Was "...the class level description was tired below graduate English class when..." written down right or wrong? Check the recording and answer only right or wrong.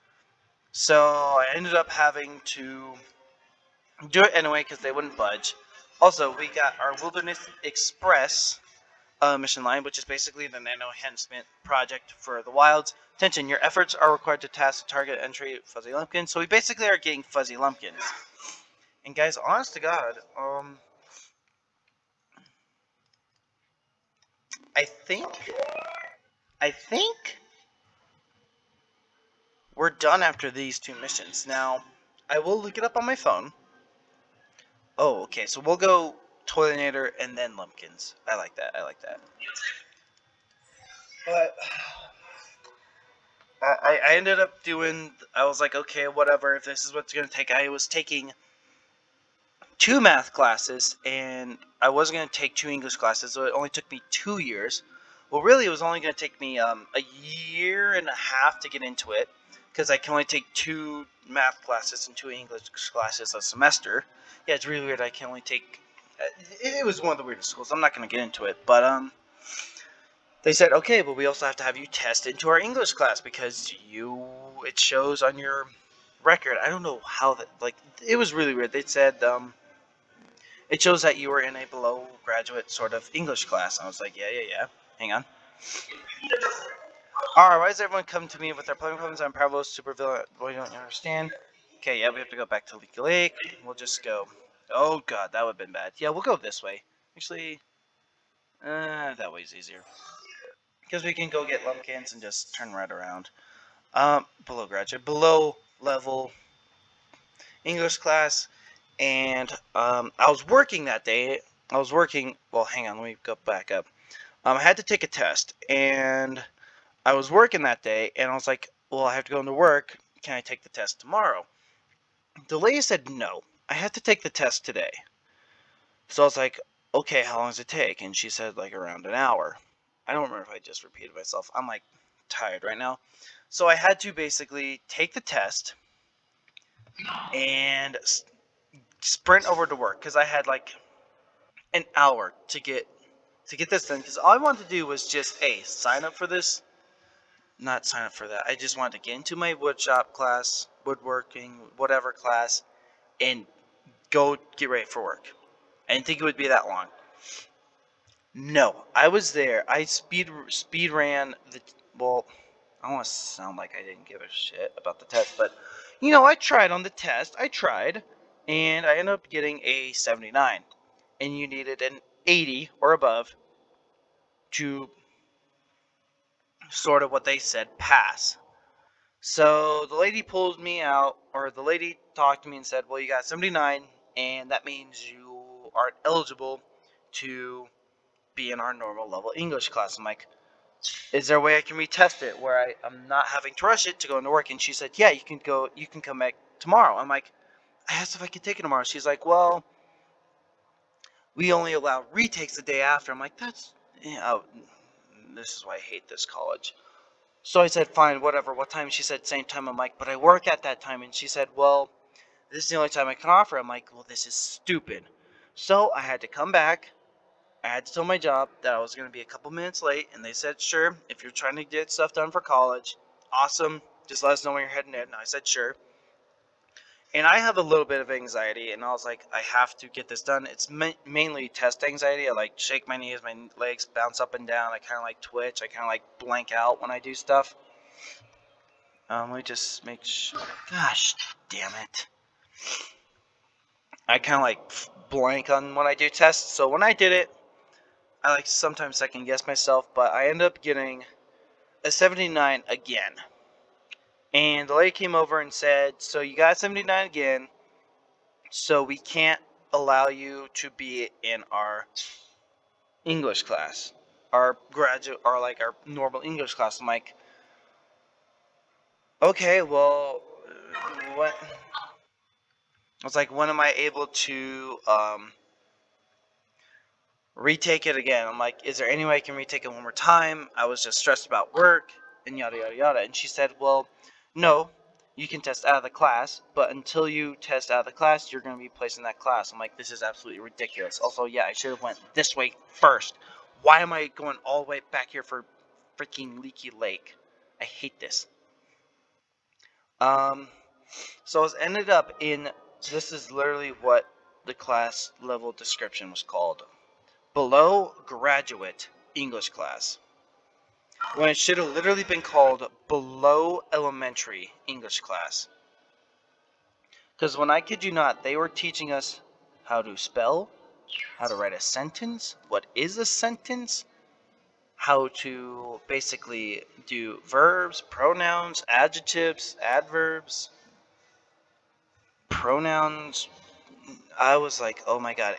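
wrong.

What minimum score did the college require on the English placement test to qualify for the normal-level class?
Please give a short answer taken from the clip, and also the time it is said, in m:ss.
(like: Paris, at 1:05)
80, at 2:52.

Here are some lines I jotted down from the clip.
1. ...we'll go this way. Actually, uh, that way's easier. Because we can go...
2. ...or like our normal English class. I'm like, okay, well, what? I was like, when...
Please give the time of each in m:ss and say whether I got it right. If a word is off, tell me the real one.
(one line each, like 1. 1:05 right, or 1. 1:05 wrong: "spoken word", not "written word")
1. 1:36 right
2. 4:25 right.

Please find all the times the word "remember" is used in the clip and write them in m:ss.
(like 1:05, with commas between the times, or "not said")
2:10.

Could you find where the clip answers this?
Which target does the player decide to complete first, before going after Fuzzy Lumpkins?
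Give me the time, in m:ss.
0:36.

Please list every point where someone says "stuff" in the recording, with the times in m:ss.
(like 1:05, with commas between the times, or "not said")
3:41, 3:57.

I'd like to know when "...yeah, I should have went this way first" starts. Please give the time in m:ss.
4:51.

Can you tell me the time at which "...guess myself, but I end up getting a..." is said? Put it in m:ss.
4:09.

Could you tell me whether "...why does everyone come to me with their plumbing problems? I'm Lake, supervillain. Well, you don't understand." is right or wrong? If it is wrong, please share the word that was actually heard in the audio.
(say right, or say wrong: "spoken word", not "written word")
wrong: "Pablo", not "Lake".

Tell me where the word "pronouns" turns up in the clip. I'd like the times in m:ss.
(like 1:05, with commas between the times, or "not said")
5:27, 5:32.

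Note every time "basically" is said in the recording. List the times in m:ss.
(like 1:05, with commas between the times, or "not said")
0:10, 0:16, 2:14, 5:25.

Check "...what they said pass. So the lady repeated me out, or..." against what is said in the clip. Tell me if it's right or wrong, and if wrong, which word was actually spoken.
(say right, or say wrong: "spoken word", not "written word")
wrong: "pulled", not "repeated".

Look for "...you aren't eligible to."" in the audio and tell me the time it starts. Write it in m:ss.
3:05.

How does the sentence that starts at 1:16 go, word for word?
I don't know how that, like, it was really weird.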